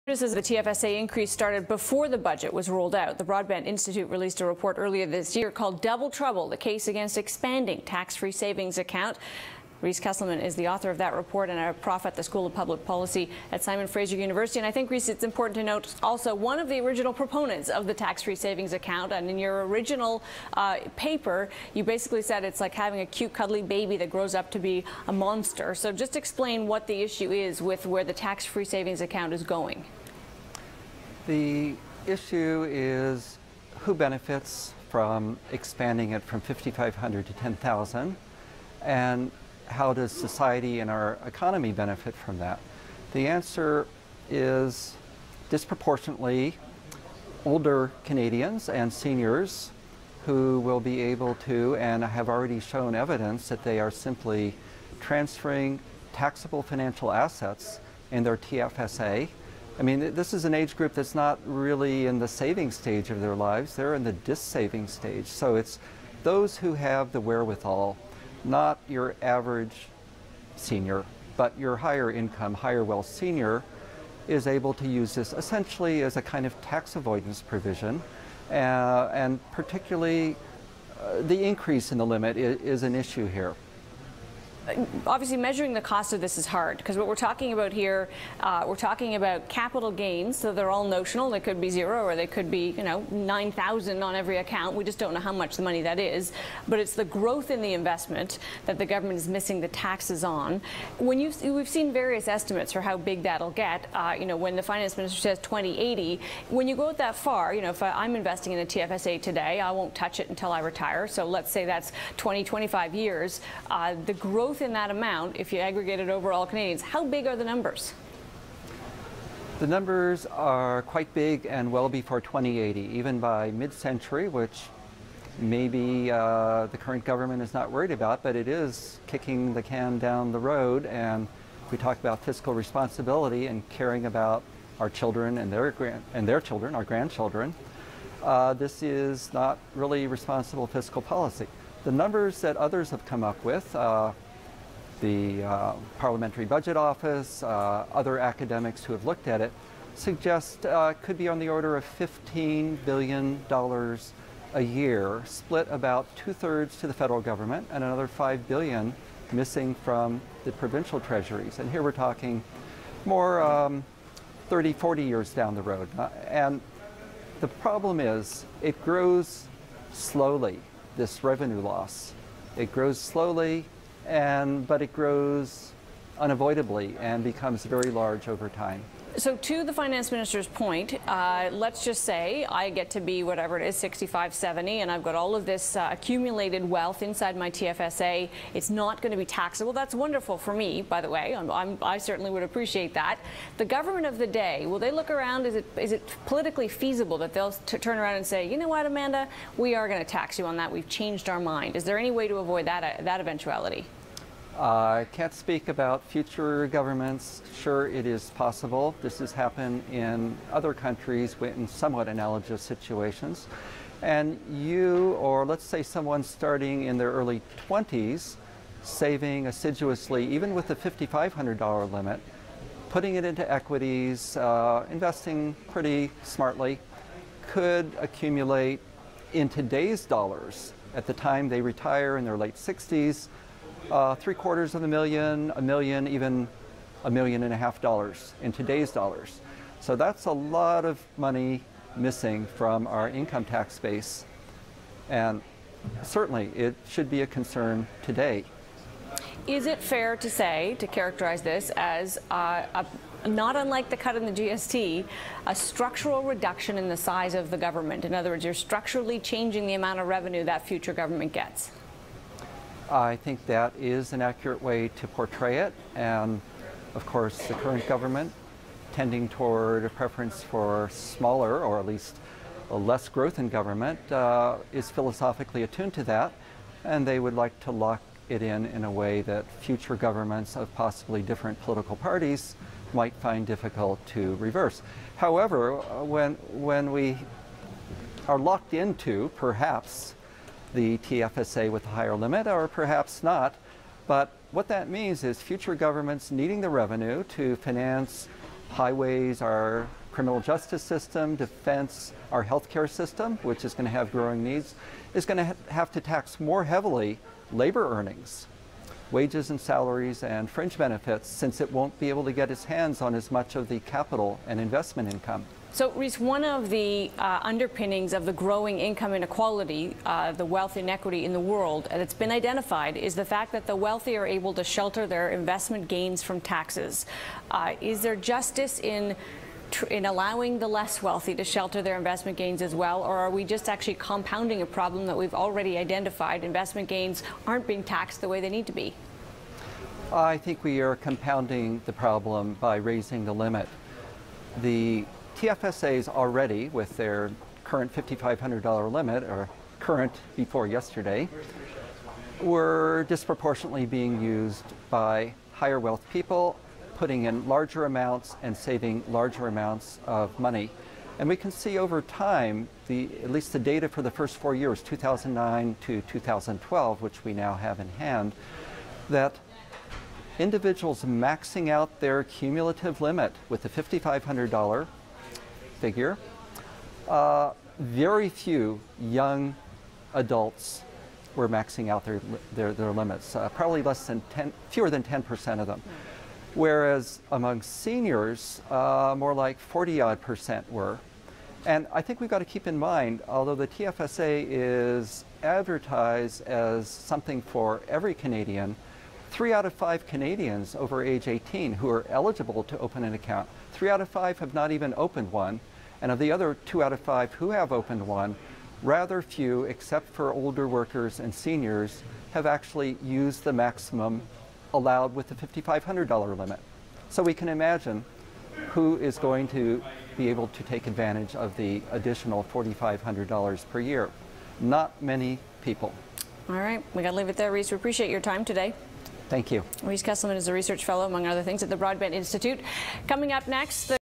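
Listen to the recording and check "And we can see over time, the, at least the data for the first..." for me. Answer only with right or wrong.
right.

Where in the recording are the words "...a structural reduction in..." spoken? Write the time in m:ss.
4:15.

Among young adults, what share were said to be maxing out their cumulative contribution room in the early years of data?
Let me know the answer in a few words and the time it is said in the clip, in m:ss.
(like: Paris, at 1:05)
fewer than 10%, at 6:24.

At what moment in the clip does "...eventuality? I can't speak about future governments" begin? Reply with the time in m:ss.
3:23.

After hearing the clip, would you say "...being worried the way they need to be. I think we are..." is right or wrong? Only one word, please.
wrong.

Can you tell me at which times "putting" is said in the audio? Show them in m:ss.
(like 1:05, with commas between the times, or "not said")
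3:42, 5:56.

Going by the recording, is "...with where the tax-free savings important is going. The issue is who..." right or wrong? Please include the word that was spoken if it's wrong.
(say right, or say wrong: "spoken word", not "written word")
wrong: "account", not "important".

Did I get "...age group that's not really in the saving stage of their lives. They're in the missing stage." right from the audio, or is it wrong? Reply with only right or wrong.
wrong.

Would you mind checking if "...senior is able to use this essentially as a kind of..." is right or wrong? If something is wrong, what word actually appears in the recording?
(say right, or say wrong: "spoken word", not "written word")
right.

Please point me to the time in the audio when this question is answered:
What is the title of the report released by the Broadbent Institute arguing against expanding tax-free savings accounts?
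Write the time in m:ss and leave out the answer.
0:05.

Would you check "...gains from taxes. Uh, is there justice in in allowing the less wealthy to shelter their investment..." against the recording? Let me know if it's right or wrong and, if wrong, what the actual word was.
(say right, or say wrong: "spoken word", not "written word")
right.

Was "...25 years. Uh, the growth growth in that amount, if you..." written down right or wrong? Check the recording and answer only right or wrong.
right.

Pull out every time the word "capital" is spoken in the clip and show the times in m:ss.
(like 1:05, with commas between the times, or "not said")
1:29, 5:13.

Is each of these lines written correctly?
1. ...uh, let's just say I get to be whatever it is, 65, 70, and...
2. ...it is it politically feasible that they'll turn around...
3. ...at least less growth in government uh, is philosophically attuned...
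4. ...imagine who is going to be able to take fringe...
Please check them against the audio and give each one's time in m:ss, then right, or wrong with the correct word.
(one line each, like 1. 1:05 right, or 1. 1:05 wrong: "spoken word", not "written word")
1. 3:01 right
2. 3:15 right
3. 4:31 right
4. 6:57 wrong: "advantage", not "fringe".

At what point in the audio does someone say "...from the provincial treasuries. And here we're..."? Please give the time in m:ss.
2:39.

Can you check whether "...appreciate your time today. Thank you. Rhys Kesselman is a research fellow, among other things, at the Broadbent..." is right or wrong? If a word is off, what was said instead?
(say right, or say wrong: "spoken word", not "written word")
right.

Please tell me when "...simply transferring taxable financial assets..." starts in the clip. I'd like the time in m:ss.
0:53.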